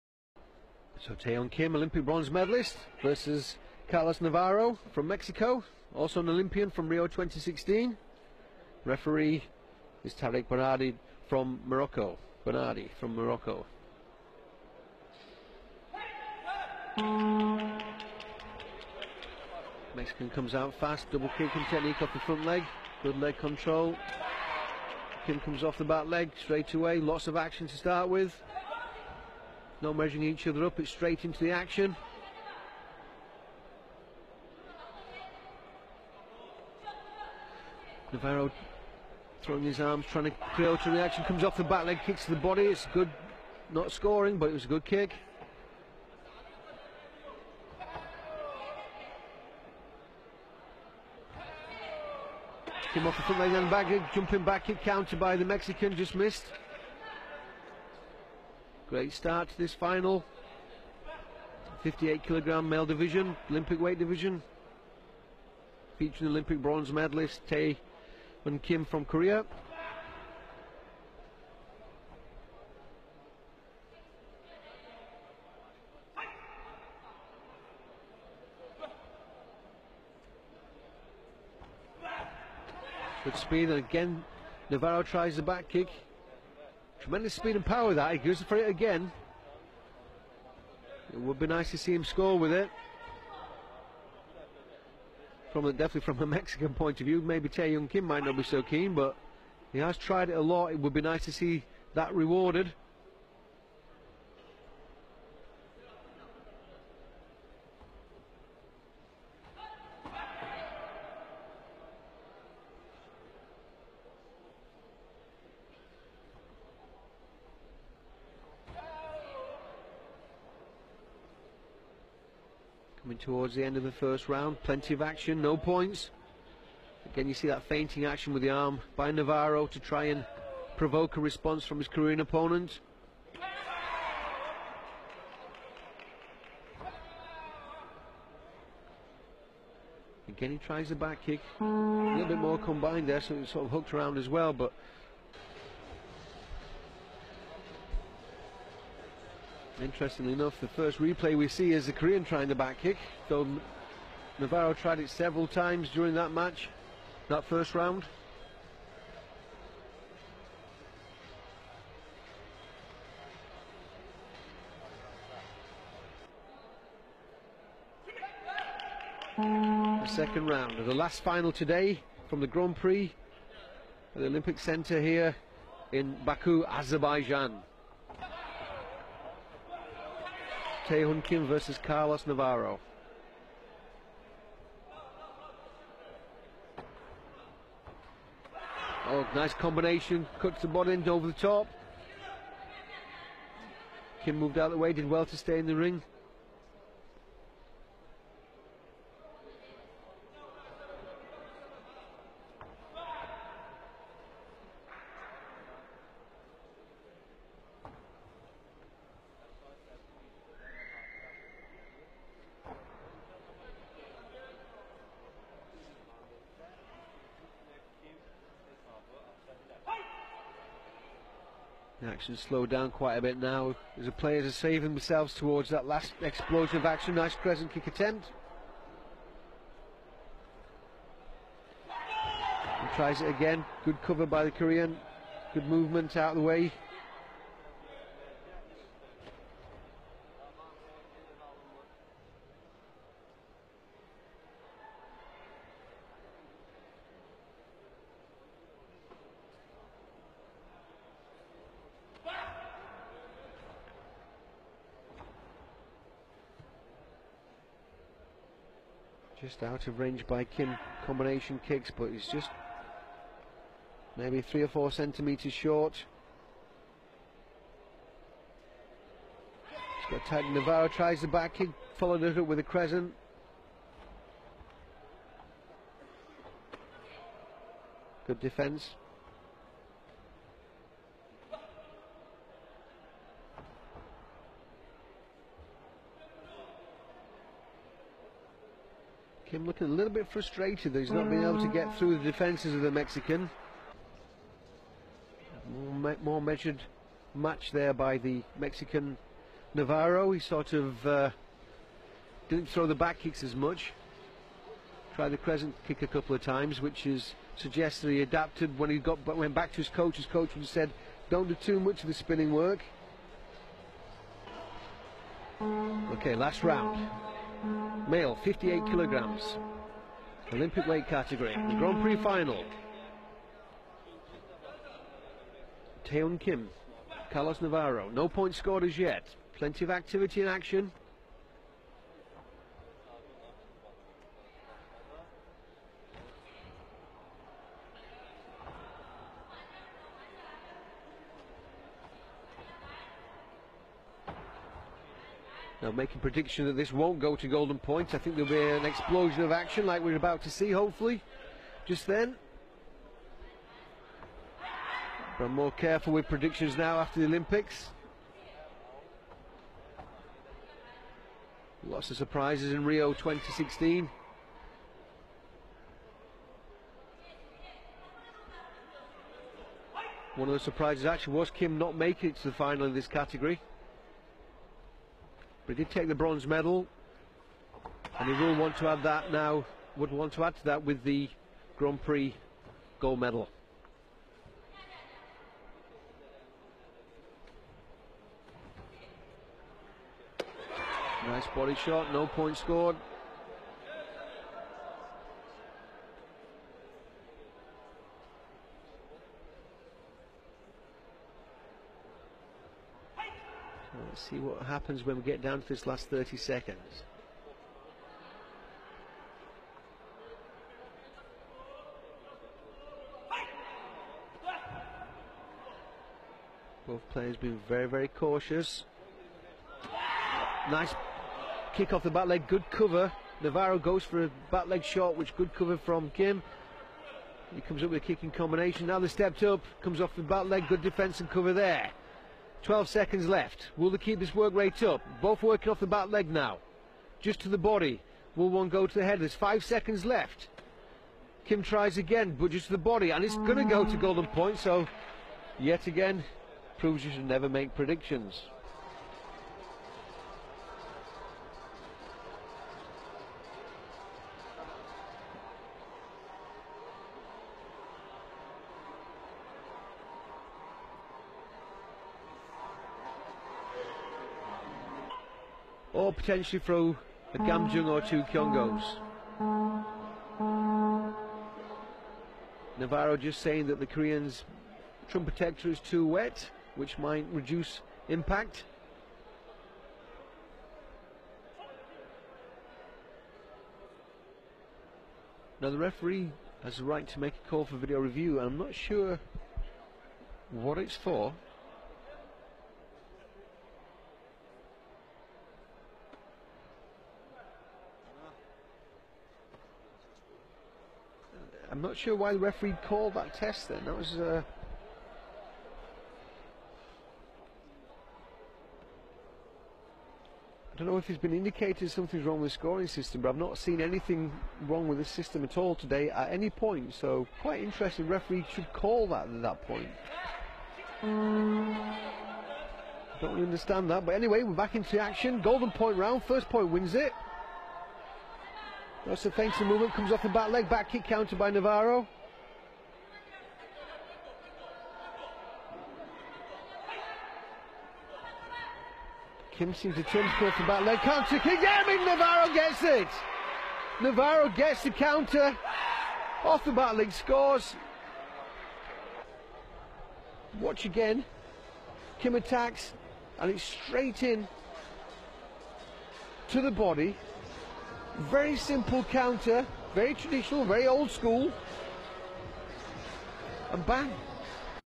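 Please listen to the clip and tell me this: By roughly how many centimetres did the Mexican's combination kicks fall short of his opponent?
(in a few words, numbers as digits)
3 or 4 centimetres.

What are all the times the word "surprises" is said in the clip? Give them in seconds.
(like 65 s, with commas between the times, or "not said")
362 s, 370 s.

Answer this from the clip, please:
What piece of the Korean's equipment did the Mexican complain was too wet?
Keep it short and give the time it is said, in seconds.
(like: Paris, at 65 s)
Trunk protector, at 475 s.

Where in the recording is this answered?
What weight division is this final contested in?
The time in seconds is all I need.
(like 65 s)
61 s.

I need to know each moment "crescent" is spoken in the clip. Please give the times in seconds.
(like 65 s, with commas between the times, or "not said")
227 s, 272 s, 305 s.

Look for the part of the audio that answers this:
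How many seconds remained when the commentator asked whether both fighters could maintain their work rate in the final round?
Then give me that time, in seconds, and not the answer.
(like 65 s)
432 s.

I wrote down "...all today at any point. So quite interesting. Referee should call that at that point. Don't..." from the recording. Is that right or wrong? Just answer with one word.
right.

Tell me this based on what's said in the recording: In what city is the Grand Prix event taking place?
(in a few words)
Baku.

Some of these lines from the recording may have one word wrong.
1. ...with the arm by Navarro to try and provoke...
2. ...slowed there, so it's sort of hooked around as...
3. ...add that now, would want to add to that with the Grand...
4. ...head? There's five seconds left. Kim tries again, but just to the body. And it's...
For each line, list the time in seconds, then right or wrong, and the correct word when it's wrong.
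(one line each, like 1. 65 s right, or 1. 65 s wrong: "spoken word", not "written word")
1. 128 s right
2. 142 s wrong: "combined", not "slowed"
3. 378 s right
4. 439 s right.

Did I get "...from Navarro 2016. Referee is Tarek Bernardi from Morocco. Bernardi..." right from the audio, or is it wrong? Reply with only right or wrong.
wrong.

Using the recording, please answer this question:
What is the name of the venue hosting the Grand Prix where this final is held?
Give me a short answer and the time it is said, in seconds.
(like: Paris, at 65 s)
Olympic Center, at 174 s.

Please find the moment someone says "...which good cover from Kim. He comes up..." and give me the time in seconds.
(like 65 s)
425 s.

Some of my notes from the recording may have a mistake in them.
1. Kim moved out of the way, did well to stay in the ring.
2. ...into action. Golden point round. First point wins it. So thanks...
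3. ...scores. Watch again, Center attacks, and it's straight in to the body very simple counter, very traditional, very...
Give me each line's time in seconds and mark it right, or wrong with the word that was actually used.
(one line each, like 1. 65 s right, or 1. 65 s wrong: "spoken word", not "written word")
1. 194 s right
2. 524 s right
3. 547 s wrong: "Kim", not "Center".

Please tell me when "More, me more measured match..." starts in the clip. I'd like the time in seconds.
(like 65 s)
295 s.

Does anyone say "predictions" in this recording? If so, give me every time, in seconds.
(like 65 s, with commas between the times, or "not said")
346 s, 356 s, 447 s.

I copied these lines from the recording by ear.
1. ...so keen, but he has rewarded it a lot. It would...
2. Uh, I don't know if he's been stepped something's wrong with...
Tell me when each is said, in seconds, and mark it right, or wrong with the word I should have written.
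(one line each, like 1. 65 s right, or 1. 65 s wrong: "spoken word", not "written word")
1. 98 s wrong: "tried", not "rewarded"
2. 504 s wrong: "indicated", not "stepped".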